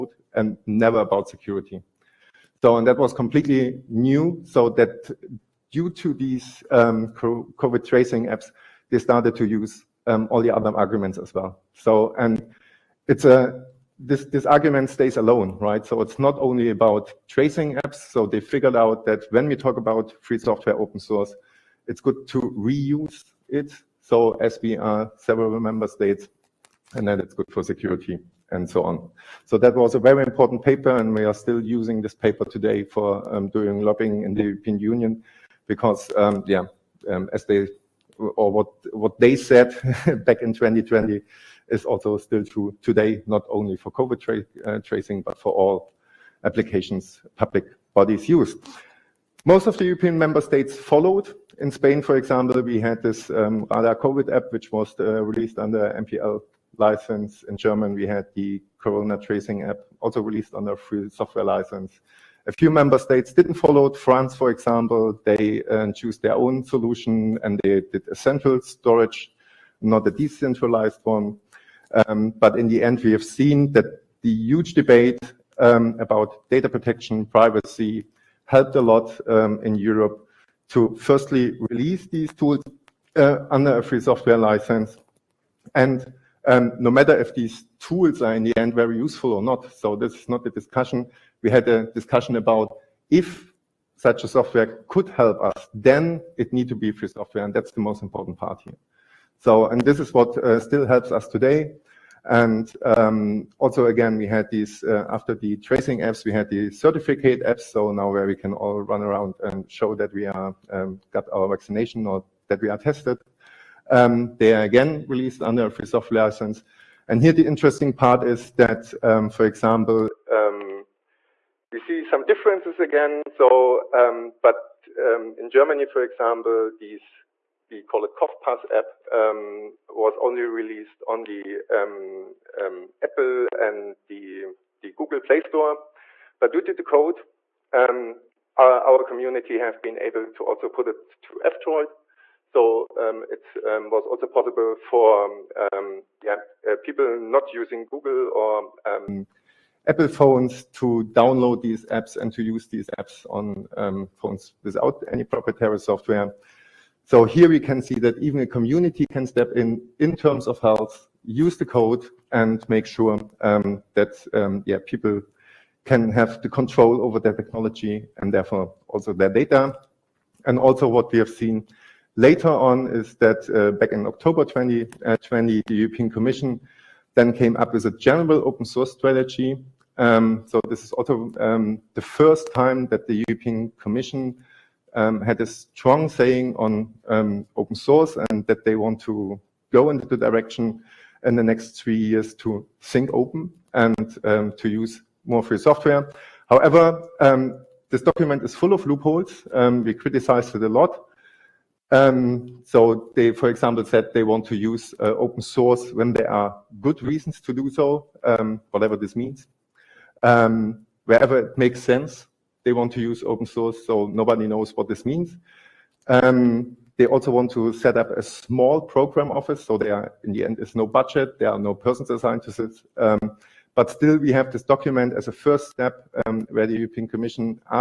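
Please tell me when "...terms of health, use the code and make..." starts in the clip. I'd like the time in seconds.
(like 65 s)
160 s.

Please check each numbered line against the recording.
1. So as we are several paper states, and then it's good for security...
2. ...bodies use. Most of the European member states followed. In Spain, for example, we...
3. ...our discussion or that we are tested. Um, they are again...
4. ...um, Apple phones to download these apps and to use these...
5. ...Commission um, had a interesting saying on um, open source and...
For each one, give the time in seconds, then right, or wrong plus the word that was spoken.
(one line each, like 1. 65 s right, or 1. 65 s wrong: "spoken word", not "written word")
1. 24 s wrong: "member", not "paper"
2. 47 s right
3. 111 s wrong: "vaccination", not "discussion"
4. 148 s right
5. 183 s wrong: "strong", not "interesting".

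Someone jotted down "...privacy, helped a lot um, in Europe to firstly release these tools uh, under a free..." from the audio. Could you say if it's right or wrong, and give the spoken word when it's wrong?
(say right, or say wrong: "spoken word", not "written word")
right.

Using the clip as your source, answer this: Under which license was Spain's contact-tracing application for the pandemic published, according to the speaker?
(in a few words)
MPL.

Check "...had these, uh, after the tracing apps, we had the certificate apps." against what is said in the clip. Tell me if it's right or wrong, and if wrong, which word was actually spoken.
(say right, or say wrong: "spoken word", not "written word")
right.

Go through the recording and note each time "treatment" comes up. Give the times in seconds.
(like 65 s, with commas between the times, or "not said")
not said.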